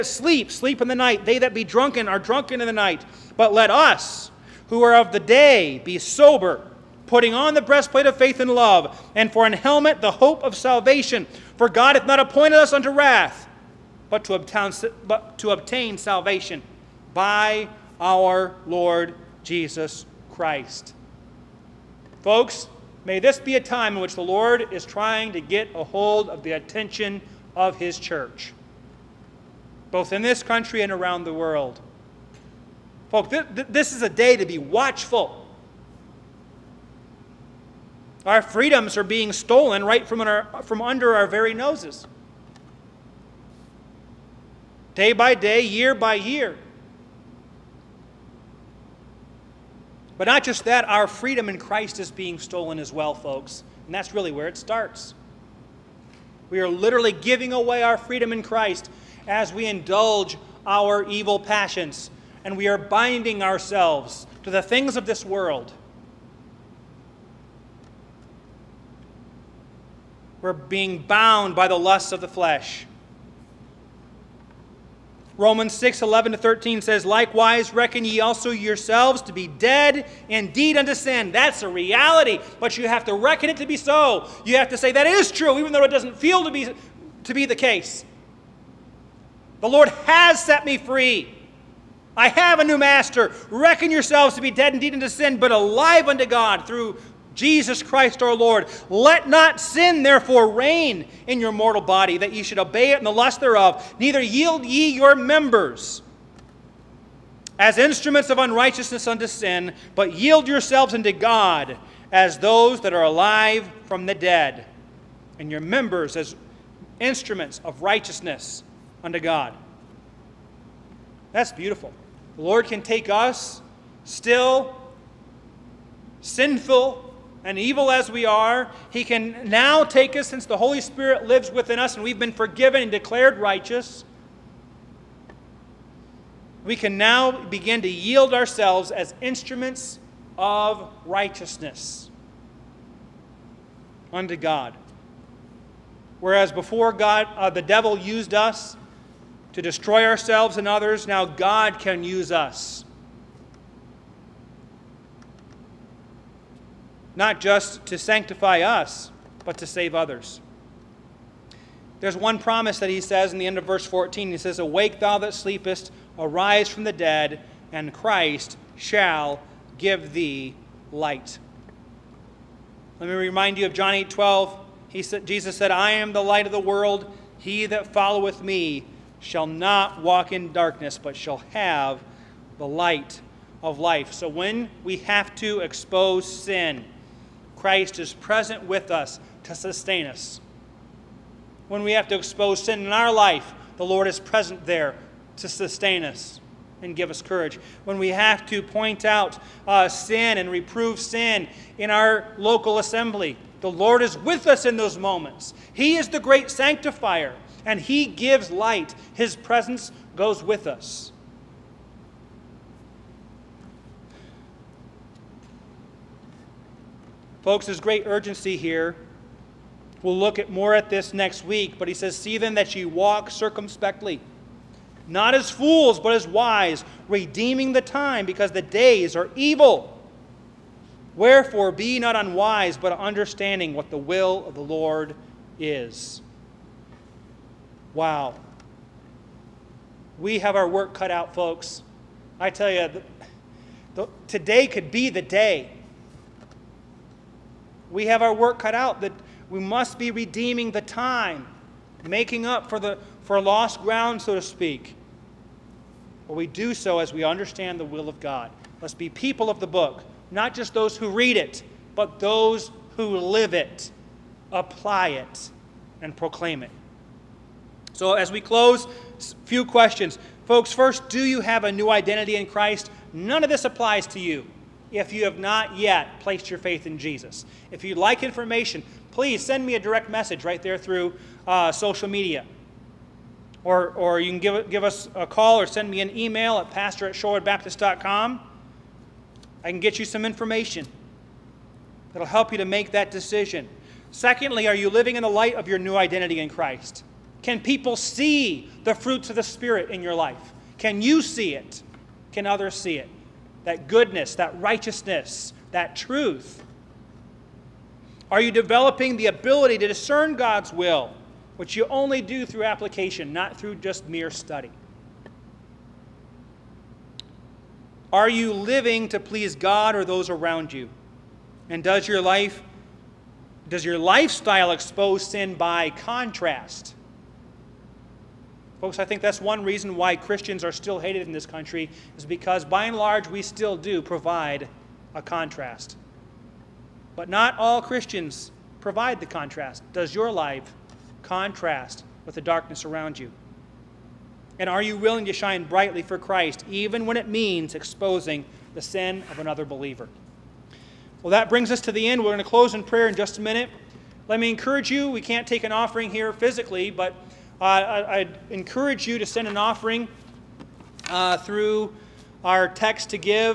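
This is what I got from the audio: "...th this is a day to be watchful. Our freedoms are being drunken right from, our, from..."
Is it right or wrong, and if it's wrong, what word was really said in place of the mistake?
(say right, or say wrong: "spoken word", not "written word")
wrong: "stolen", not "drunken".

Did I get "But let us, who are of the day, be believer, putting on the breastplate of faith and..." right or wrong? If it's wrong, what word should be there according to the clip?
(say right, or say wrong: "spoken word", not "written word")
wrong: "sober", not "believer".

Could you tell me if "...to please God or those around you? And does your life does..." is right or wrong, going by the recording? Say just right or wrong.
right.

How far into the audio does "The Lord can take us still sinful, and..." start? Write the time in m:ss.
2:02.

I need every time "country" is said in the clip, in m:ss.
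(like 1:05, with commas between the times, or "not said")
0:30, 5:31.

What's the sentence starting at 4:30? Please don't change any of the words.
Folks, first, do you have a new identity in Christ?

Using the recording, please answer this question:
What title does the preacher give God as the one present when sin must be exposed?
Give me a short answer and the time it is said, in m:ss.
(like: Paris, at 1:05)
the great sanctifier, at 3:26.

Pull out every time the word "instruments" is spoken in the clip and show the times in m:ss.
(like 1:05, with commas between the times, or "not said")
1:47, 1:56, 2:19.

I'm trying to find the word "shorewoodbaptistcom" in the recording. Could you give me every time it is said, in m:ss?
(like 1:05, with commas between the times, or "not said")
4:47.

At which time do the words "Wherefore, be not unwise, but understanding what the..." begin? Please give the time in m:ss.
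3:51.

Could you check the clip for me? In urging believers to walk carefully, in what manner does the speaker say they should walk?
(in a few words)
circumspectly.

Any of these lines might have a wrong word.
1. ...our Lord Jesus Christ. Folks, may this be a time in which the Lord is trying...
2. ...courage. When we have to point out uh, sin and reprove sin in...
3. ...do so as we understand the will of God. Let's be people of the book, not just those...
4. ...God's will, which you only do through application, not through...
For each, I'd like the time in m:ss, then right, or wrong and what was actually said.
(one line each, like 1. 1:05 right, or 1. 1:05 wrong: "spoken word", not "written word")
1. 0:17 right
2. 3:17 right
3. 4:16 right
4. 5:10 right.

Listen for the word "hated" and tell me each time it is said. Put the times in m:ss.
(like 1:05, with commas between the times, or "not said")
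5:30.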